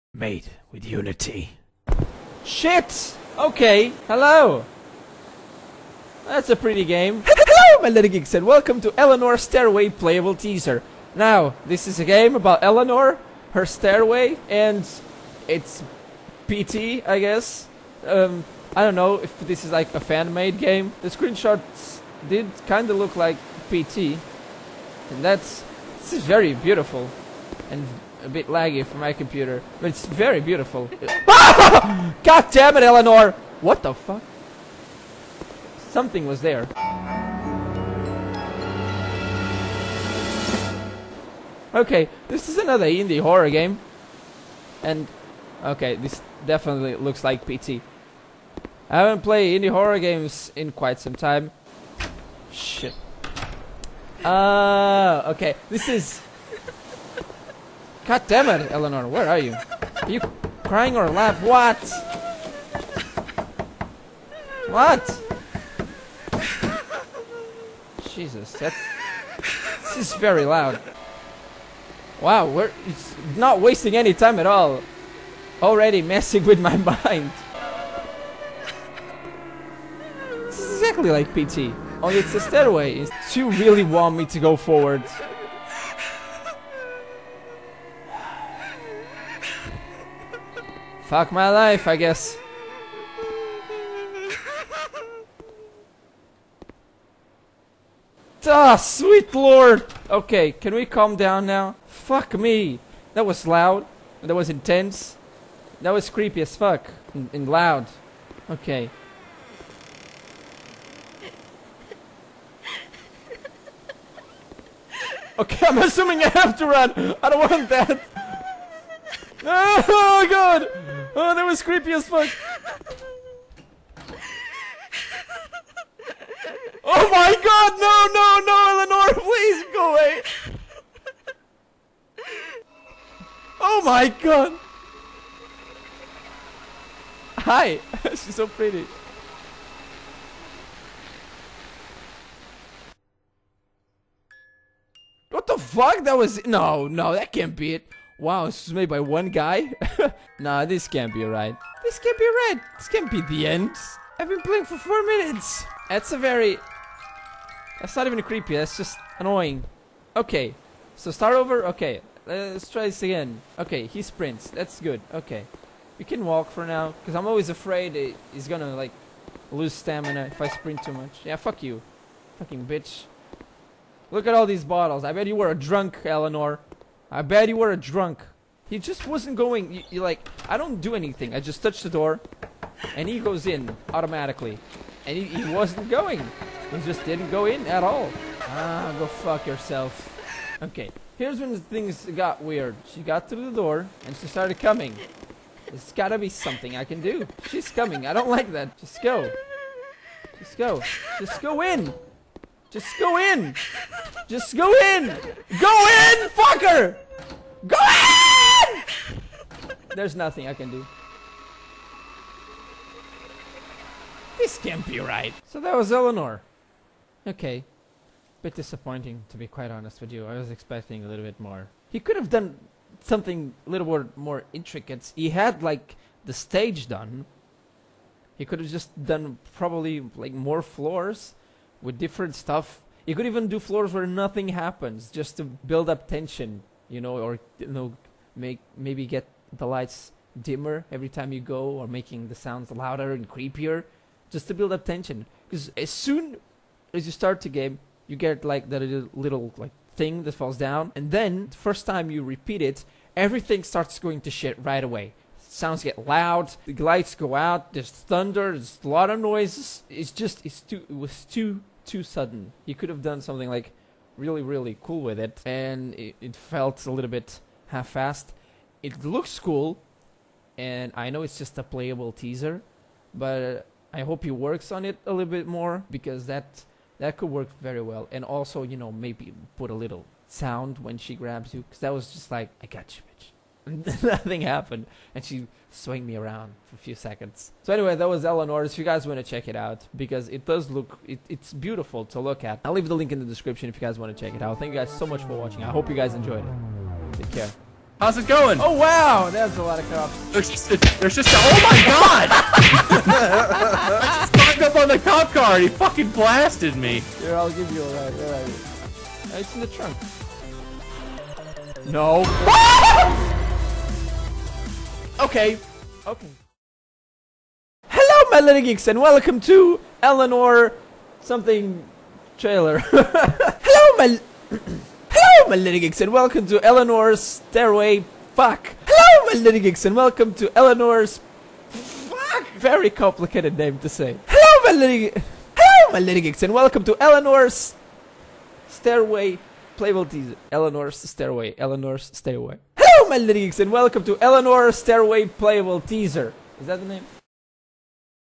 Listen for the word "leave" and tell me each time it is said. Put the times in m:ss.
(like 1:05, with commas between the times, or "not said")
4:52.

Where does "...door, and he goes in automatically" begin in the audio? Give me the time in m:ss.
3:01.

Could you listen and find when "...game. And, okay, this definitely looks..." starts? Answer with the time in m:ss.
0:43.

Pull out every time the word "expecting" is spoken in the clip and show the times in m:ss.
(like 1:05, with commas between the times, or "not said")
3:40.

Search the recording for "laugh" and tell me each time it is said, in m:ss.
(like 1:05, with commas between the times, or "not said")
1:01.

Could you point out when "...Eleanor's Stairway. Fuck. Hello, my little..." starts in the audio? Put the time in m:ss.
5:26.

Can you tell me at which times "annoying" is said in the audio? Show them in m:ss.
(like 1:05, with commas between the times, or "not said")
2:39.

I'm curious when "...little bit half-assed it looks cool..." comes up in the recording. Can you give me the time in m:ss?
4:26.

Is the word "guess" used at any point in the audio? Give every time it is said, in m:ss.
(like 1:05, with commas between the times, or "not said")
0:17, 1:31.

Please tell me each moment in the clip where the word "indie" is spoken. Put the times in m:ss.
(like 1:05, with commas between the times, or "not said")
0:42, 0:49.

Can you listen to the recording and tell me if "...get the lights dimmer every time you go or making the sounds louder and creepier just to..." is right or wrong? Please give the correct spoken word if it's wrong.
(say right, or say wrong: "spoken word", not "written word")
right.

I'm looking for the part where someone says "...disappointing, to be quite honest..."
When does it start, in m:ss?
3:38.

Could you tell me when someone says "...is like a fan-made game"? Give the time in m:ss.
0:19.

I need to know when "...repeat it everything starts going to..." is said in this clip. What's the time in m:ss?
4:12.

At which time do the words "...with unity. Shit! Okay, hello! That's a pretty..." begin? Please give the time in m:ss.
0:00.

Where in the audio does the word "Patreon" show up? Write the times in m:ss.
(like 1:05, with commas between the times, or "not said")
not said.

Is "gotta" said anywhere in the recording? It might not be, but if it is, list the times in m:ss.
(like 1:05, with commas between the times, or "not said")
3:15.